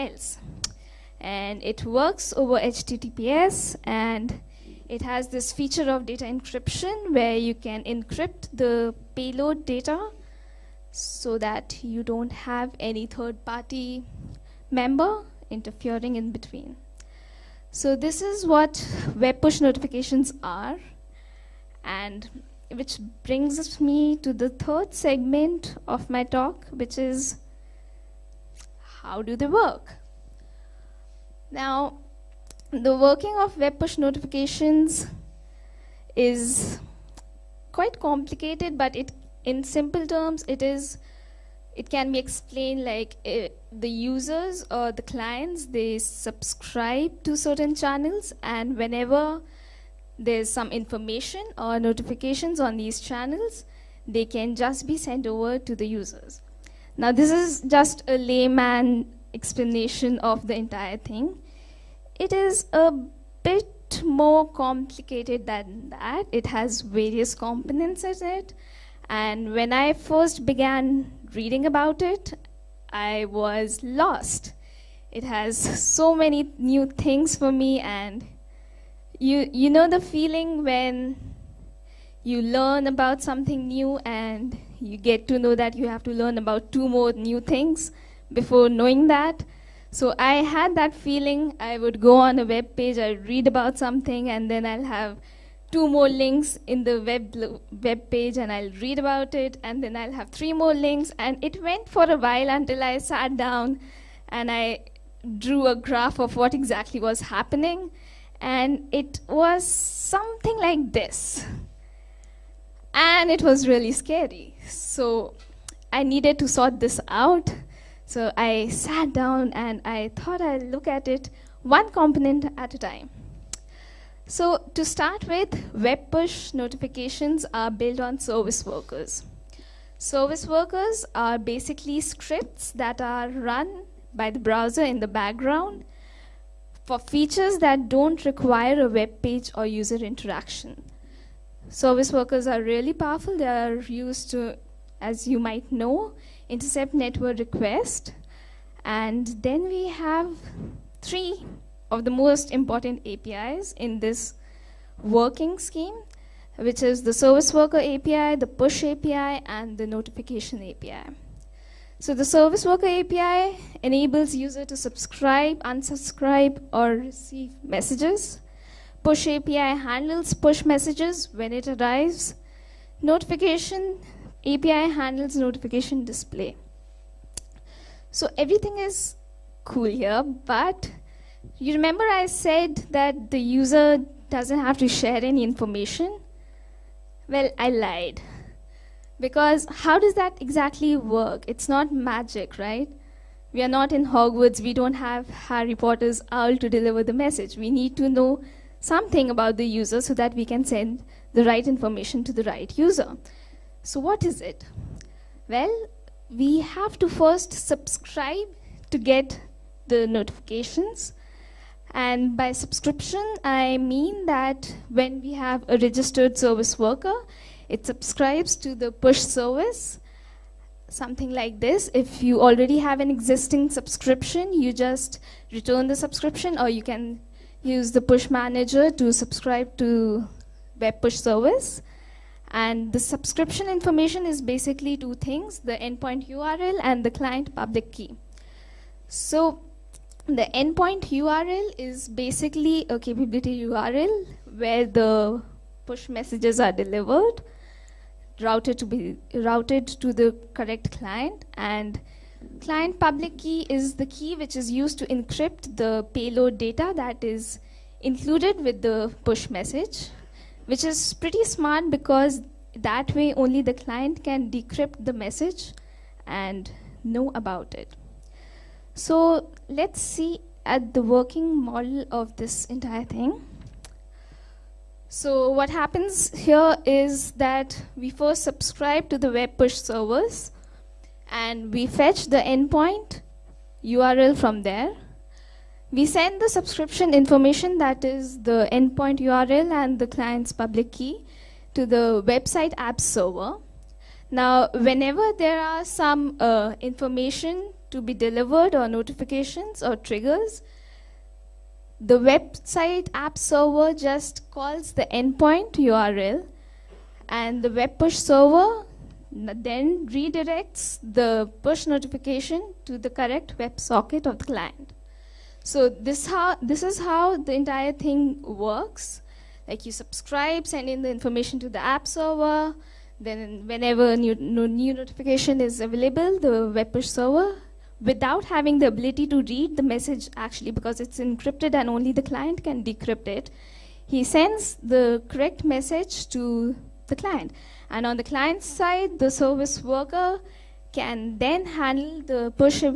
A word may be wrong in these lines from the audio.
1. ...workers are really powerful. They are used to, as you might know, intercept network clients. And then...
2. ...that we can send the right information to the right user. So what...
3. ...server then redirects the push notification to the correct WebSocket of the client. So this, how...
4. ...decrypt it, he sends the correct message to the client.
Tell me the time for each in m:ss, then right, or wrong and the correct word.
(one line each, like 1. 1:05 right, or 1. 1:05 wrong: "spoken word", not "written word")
1. 2:22 wrong: "requests", not "clients"
2. 3:20 right
3. 5:08 right
4. 5:32 right.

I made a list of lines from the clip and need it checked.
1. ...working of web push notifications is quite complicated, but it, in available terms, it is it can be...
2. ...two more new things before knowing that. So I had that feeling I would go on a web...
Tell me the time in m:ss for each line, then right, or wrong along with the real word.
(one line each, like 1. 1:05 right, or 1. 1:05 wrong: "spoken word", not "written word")
1. 0:32 wrong: "simple", not "available"
2. 1:26 right.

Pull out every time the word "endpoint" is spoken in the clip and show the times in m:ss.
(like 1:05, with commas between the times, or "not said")
3:55, 4:00, 4:42, 4:48, 5:05.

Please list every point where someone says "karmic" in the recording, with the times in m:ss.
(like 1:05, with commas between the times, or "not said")
not said.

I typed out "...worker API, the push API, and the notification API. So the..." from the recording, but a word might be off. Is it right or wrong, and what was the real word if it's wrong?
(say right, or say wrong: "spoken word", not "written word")
right.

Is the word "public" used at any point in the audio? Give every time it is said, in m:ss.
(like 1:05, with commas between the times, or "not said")
3:57, 4:12, 4:50.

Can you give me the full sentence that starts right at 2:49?
Push API handles push messages when it arrives.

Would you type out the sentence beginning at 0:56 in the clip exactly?
Now, this is just a layman explanation of the entire thing.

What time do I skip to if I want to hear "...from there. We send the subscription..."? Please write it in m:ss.
4:44.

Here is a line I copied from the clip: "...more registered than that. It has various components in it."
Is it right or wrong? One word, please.
wrong.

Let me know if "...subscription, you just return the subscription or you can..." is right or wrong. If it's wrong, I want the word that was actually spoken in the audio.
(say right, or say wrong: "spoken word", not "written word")
right.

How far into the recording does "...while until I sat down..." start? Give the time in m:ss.
1:42.